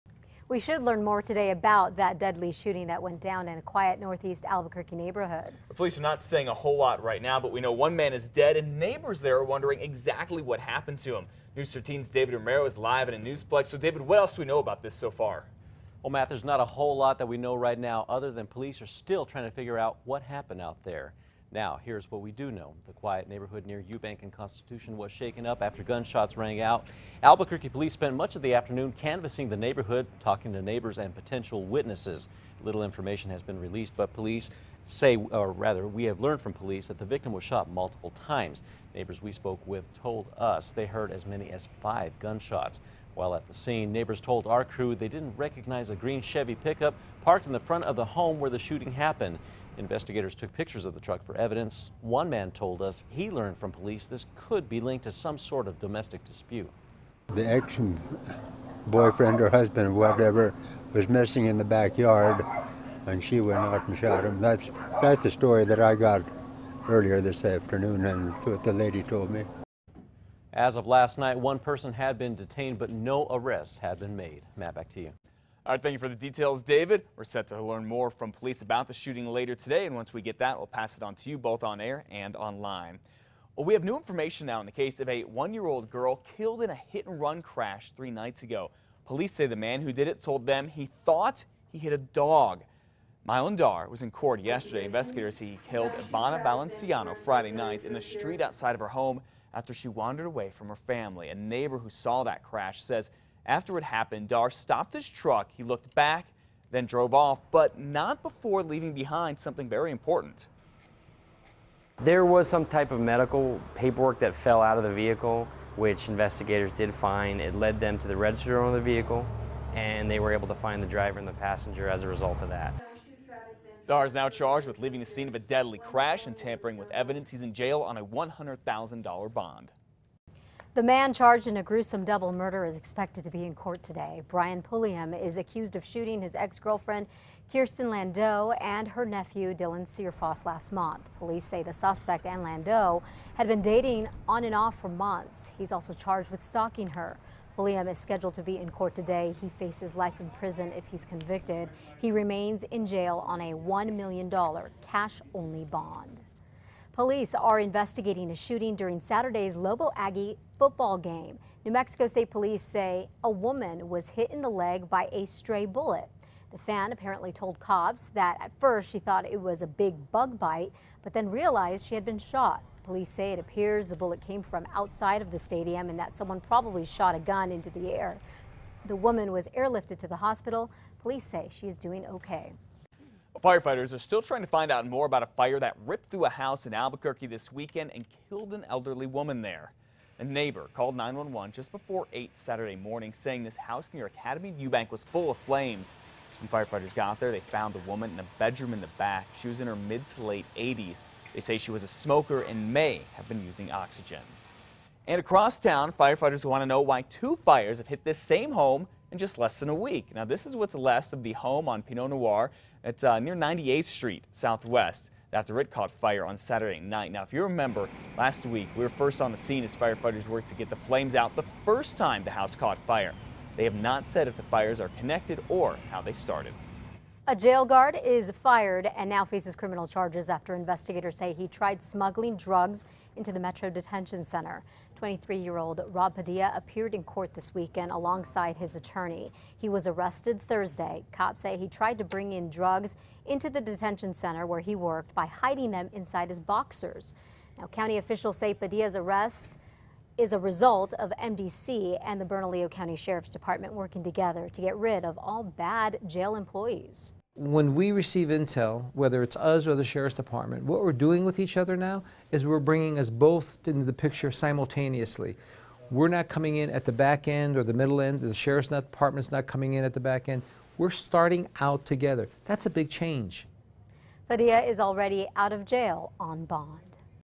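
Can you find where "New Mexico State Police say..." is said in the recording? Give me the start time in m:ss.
2:41.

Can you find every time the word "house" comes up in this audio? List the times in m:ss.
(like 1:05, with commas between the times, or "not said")
3:06, 3:13, 3:42.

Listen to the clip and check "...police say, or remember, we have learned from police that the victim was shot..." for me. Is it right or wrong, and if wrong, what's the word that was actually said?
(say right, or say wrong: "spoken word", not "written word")
wrong: "rather", not "remember".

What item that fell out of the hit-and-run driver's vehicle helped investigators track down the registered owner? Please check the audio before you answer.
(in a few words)
medical paperwork.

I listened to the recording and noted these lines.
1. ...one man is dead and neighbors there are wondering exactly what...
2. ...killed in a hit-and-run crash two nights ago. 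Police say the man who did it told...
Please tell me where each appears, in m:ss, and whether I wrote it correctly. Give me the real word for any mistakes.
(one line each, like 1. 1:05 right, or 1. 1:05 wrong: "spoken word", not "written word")
1. 0:07 right
2. 1:26 wrong: "three", not "two".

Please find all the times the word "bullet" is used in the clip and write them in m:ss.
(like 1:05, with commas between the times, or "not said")
2:45, 2:53.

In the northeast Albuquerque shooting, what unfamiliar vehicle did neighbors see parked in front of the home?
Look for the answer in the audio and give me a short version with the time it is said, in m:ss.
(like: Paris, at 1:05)
green Chevy pickup, at 0:45.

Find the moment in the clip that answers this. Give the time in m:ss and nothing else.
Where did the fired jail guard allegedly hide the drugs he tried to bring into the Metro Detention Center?
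4:05.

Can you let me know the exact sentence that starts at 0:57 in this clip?
The ex boyfriend or husband or whatever was missing in the backyard and she went out and shot him.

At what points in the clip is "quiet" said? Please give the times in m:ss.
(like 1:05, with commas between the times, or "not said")
0:03, 0:22.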